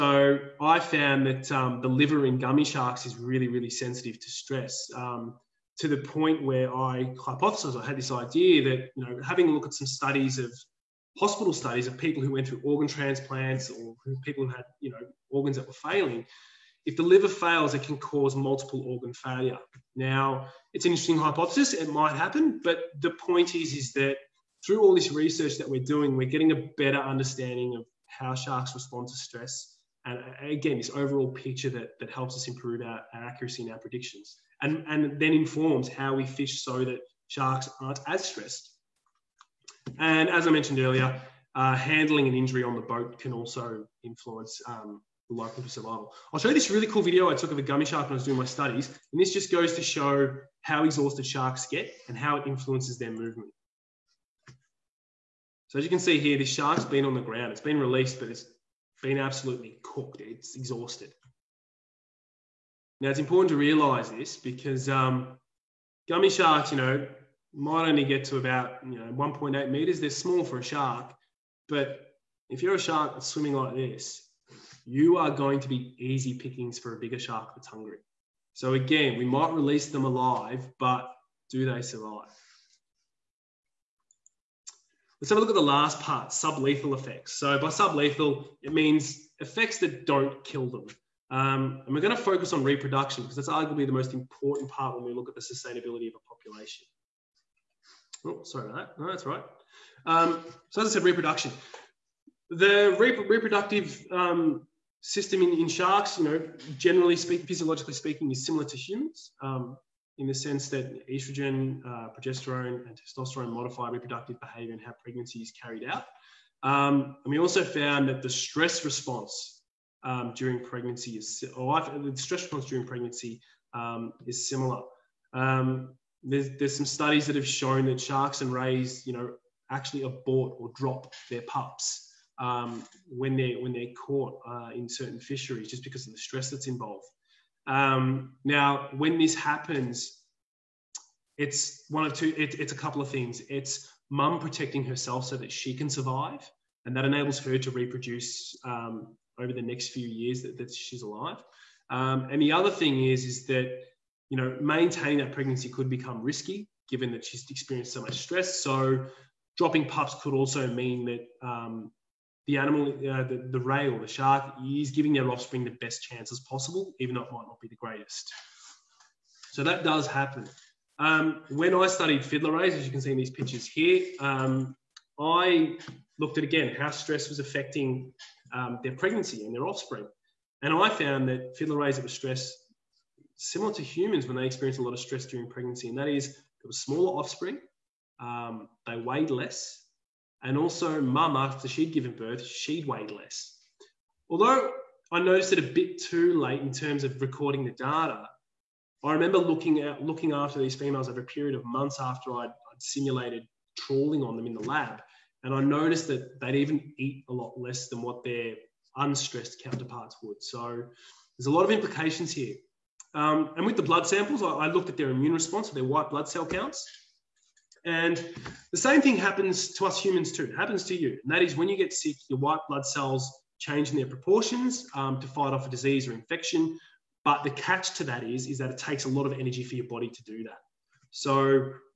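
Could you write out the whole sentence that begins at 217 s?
And the same thing happens to us humans too.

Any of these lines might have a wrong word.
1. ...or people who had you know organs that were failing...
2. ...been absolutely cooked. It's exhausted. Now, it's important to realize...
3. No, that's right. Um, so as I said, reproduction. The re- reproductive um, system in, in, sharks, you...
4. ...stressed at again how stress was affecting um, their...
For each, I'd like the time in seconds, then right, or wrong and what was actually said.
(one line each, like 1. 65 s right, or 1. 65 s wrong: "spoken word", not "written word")
1. 13 s right
2. 59 s right
3. 99 s right
4. 176 s wrong: "looked", not "stressed".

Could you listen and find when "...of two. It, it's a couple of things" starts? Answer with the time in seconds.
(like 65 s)
142 s.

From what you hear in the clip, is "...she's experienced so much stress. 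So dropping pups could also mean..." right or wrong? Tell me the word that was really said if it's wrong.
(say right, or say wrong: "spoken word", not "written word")
right.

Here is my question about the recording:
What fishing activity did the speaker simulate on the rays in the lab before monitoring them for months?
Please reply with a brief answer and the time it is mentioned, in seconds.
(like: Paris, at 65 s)
Trawling, at 203 s.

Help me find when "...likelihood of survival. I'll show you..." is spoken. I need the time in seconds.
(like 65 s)
45 s.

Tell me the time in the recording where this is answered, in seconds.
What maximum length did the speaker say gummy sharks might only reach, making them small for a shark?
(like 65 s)
69 s.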